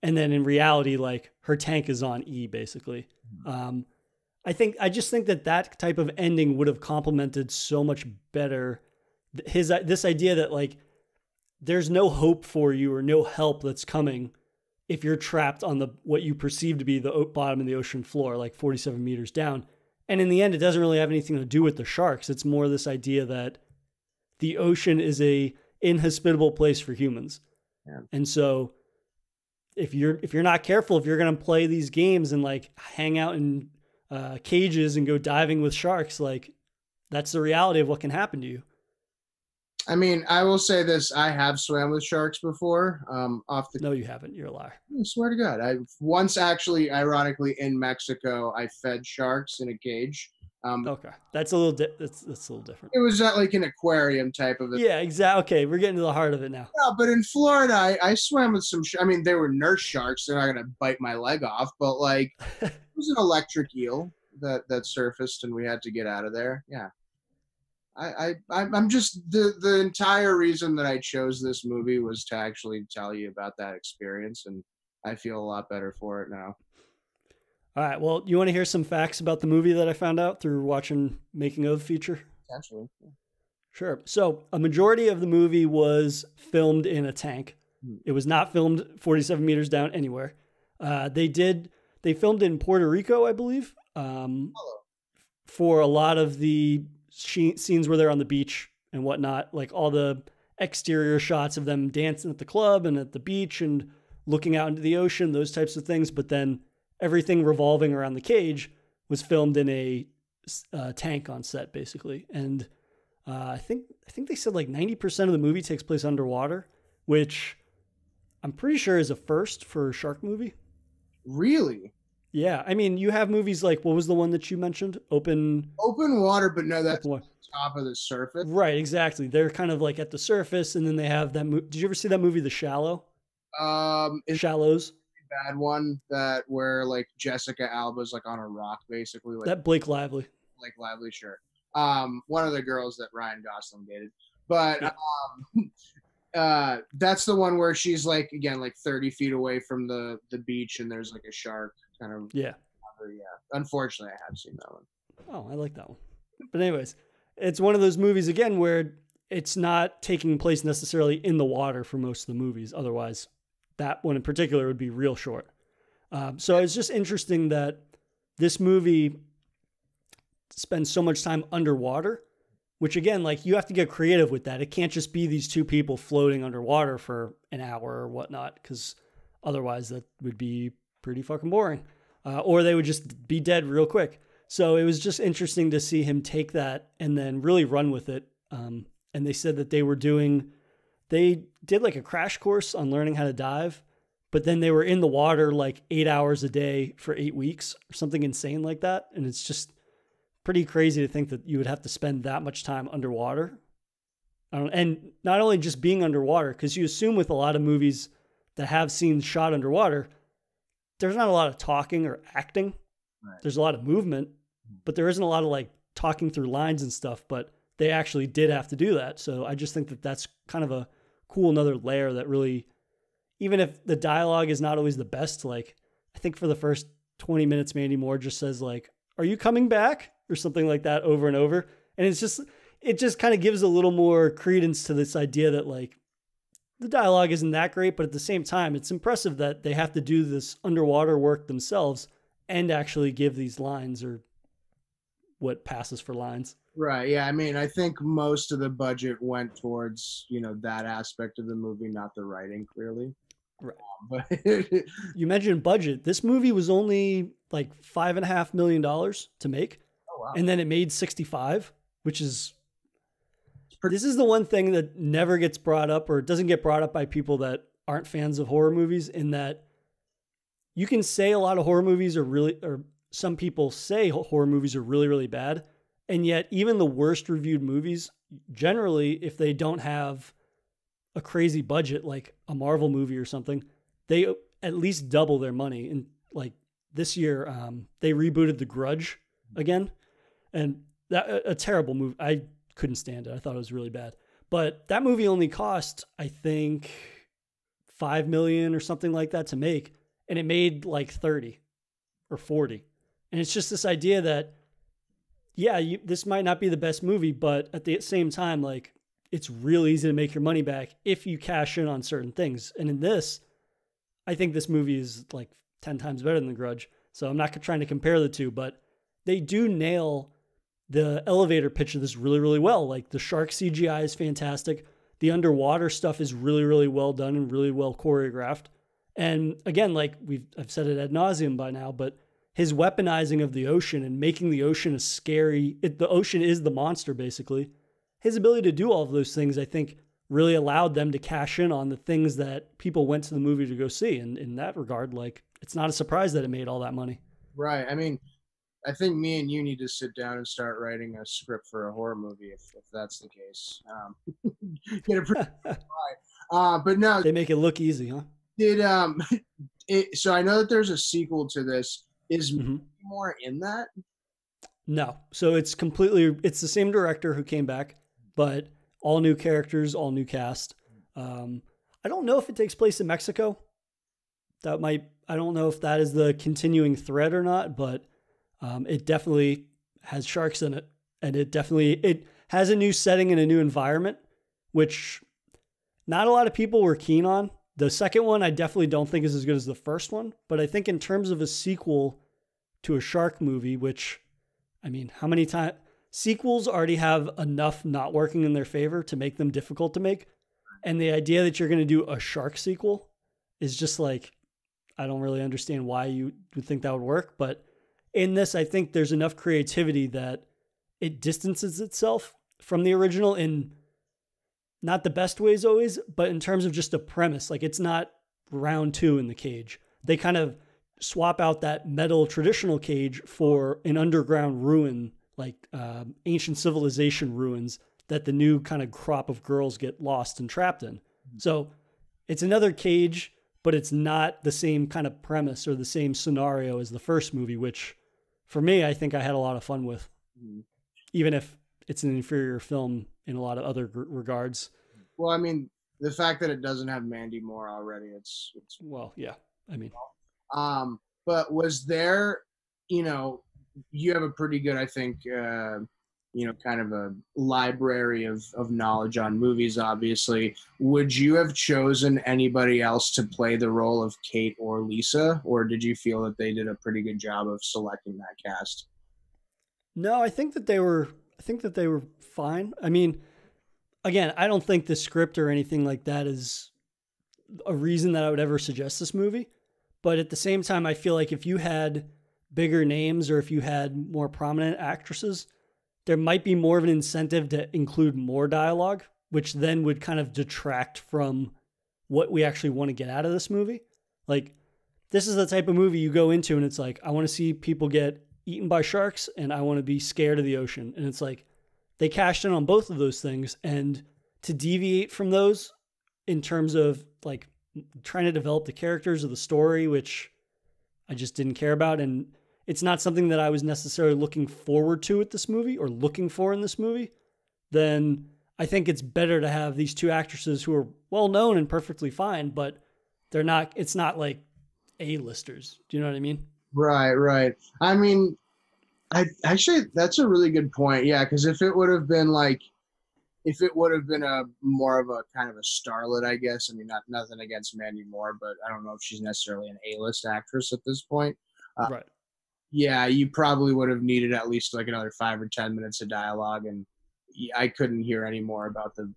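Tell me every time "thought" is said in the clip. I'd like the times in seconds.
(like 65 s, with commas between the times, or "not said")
293 s.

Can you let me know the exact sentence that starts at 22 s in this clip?
It's more this idea that the ocean is a inhospitable place for humans.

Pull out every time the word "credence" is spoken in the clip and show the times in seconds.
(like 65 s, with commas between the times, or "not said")
234 s.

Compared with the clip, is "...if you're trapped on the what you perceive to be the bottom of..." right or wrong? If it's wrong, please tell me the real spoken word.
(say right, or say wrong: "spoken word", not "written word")
right.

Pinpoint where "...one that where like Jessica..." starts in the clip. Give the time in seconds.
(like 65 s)
135 s.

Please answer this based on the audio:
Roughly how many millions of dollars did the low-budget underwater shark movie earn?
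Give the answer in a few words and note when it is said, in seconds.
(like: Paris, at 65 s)
65, at 260 s.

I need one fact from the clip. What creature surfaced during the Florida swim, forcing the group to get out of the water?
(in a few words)
Electric eel.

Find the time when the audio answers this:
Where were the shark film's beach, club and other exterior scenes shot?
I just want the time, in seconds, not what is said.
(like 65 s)
92 s.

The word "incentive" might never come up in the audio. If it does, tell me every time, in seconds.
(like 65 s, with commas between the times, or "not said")
486 s.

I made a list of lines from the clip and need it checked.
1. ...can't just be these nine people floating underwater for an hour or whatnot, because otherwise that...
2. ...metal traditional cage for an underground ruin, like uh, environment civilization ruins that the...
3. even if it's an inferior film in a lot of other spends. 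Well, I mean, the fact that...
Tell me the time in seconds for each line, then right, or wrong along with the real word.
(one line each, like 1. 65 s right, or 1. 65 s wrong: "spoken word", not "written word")
1. 174 s wrong: "two", not "nine"
2. 421 s wrong: "ancient", not "environment"
3. 441 s wrong: "regards", not "spends".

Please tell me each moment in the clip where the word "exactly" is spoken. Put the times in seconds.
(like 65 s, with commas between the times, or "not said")
54 s, 128 s.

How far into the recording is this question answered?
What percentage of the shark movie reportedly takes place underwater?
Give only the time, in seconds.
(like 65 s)
114 s.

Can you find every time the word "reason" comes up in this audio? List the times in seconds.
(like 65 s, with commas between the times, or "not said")
70 s, 477 s.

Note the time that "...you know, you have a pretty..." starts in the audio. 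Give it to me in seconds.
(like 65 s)
452 s.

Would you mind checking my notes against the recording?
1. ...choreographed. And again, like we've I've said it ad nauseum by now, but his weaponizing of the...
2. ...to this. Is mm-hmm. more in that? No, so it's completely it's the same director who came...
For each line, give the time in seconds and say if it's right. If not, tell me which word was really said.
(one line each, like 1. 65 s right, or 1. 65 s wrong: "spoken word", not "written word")
1. 327 s right
2. 361 s right.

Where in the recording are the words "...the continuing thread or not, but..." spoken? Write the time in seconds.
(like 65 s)
376 s.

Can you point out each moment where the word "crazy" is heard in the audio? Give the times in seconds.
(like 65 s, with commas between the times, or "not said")
200 s, 281 s.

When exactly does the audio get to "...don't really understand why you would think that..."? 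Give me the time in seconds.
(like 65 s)
405 s.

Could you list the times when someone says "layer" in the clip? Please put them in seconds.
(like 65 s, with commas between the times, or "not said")
221 s.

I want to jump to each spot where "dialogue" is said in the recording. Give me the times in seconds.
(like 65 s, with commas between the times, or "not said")
223 s, 236 s, 488 s, 546 s.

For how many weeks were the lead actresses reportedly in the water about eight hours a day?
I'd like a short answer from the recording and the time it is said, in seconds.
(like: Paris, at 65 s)
8, at 197 s.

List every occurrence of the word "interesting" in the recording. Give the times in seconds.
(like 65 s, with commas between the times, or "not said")
166 s, 185 s.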